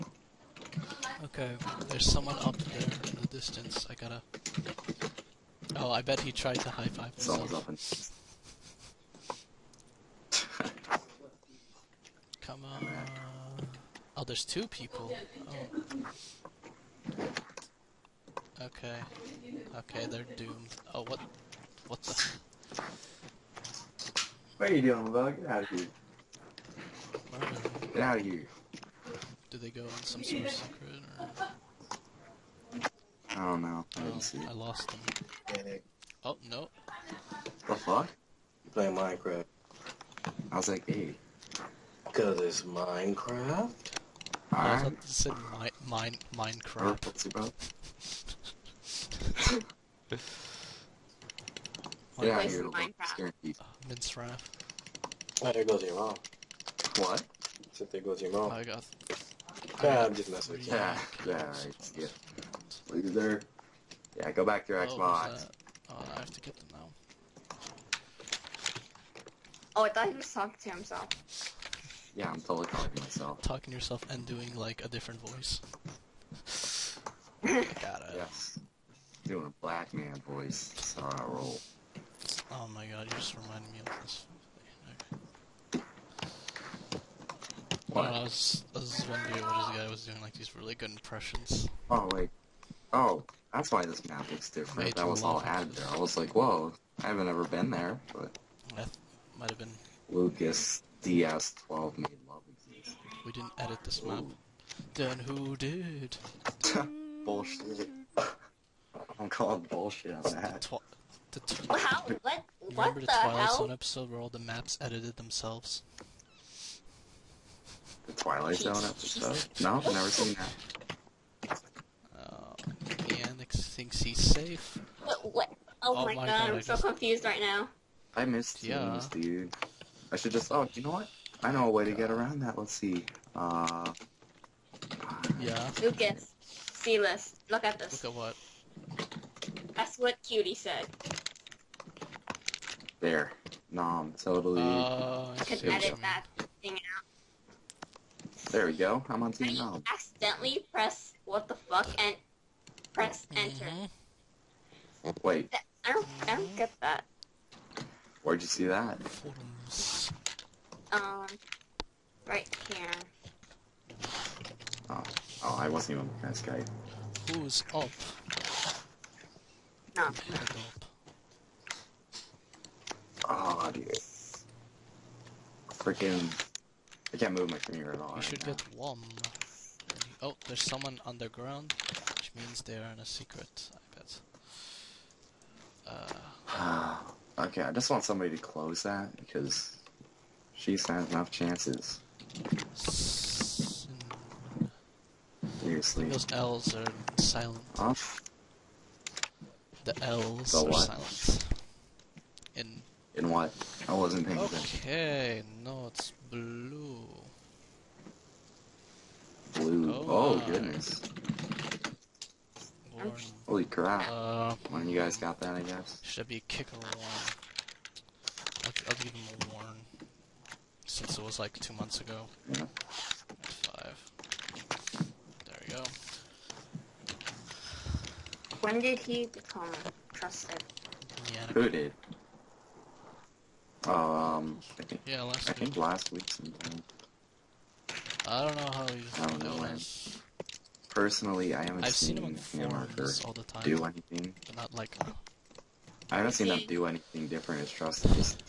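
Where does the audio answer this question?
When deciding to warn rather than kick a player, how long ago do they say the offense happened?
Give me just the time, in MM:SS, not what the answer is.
03:41.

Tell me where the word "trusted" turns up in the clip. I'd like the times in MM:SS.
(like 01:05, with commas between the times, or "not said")
03:50, 04:07.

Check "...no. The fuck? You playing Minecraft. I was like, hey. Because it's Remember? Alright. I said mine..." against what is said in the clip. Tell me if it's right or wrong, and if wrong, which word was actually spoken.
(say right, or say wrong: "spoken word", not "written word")
wrong: "Minecraft", not "Remember".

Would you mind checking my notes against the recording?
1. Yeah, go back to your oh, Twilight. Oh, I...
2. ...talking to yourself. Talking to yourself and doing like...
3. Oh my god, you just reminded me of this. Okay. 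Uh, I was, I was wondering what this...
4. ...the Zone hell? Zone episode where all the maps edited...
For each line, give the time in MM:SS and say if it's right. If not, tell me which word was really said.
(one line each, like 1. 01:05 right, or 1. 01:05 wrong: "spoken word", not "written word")
1. 01:04 wrong: "Xbox", not "Twilight"
2. 01:12 wrong: "myself", not "yourself"
3. 01:22 right
4. 01:53 wrong: "Twilight", not "Zone".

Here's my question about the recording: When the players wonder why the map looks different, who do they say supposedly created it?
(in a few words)
Lucas DS12.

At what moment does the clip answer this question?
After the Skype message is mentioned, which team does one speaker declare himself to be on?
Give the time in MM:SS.
02:29.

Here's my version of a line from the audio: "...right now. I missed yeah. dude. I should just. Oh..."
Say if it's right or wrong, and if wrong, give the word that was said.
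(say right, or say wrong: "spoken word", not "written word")
right.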